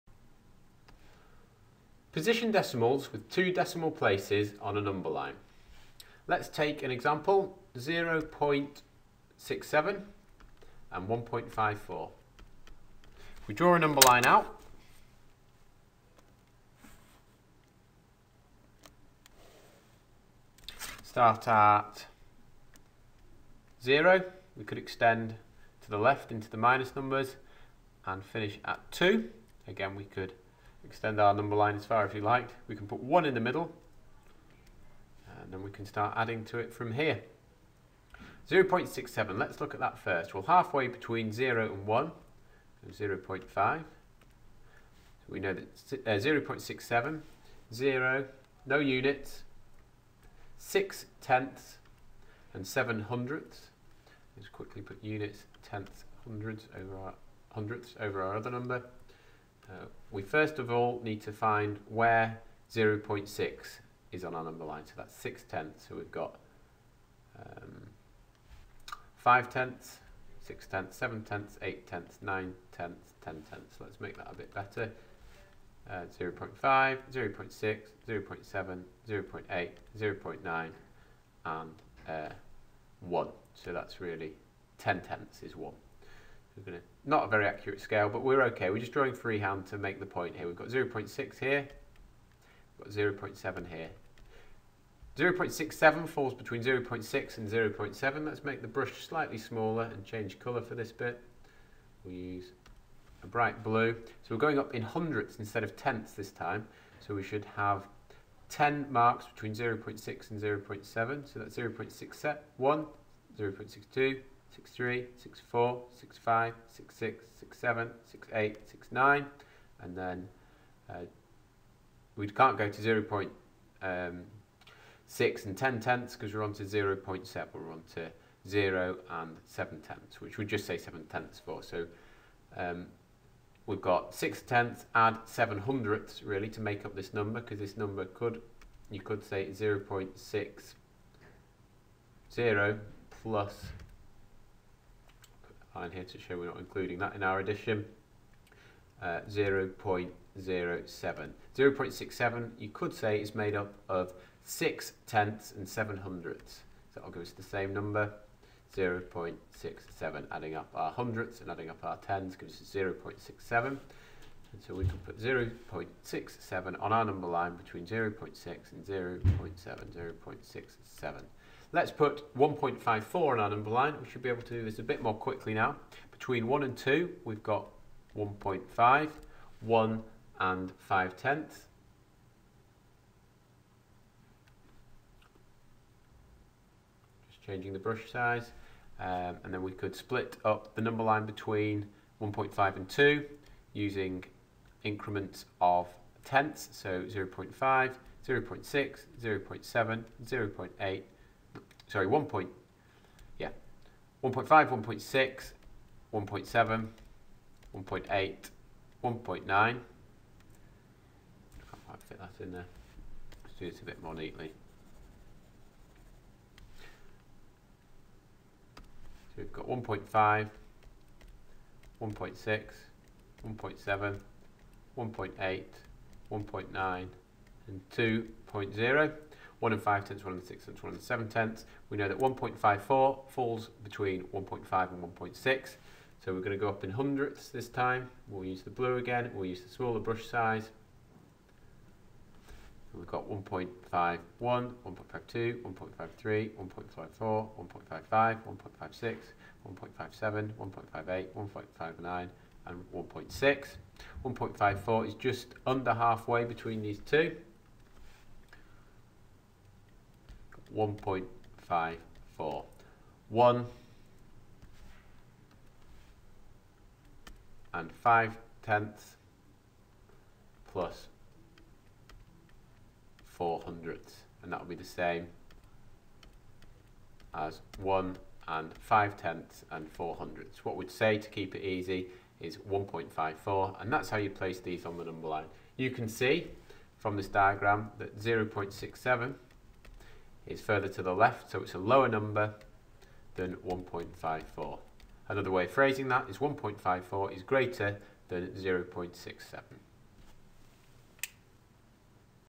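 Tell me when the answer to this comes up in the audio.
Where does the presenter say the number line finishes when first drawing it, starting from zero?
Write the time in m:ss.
0:28.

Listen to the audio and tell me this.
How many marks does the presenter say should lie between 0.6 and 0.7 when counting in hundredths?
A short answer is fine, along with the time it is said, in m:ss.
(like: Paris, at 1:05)
10, at 1:48.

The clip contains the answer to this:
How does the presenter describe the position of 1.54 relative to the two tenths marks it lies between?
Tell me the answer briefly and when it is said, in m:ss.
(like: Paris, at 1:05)
just under halfway, at 4:15.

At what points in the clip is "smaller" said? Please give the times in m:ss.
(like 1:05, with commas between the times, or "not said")
1:39, 3:59.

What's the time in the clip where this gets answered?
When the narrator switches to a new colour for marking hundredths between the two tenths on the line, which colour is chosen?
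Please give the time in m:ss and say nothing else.
1:43.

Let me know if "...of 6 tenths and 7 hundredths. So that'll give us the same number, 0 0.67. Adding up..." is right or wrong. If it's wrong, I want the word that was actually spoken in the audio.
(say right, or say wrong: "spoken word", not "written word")
right.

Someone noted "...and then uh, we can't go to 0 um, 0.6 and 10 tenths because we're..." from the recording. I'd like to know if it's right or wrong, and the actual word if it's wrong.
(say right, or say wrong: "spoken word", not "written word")
right.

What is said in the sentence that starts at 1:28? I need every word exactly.
We're just drawing freehand to make the point here.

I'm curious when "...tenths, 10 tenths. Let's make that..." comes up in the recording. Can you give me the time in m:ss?
1:12.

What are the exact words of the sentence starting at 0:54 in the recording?
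Let's quickly put units, tenths, hundreds over our hundredths over our other number.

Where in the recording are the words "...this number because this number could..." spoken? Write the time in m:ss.
2:16.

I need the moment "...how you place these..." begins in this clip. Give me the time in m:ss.
4:44.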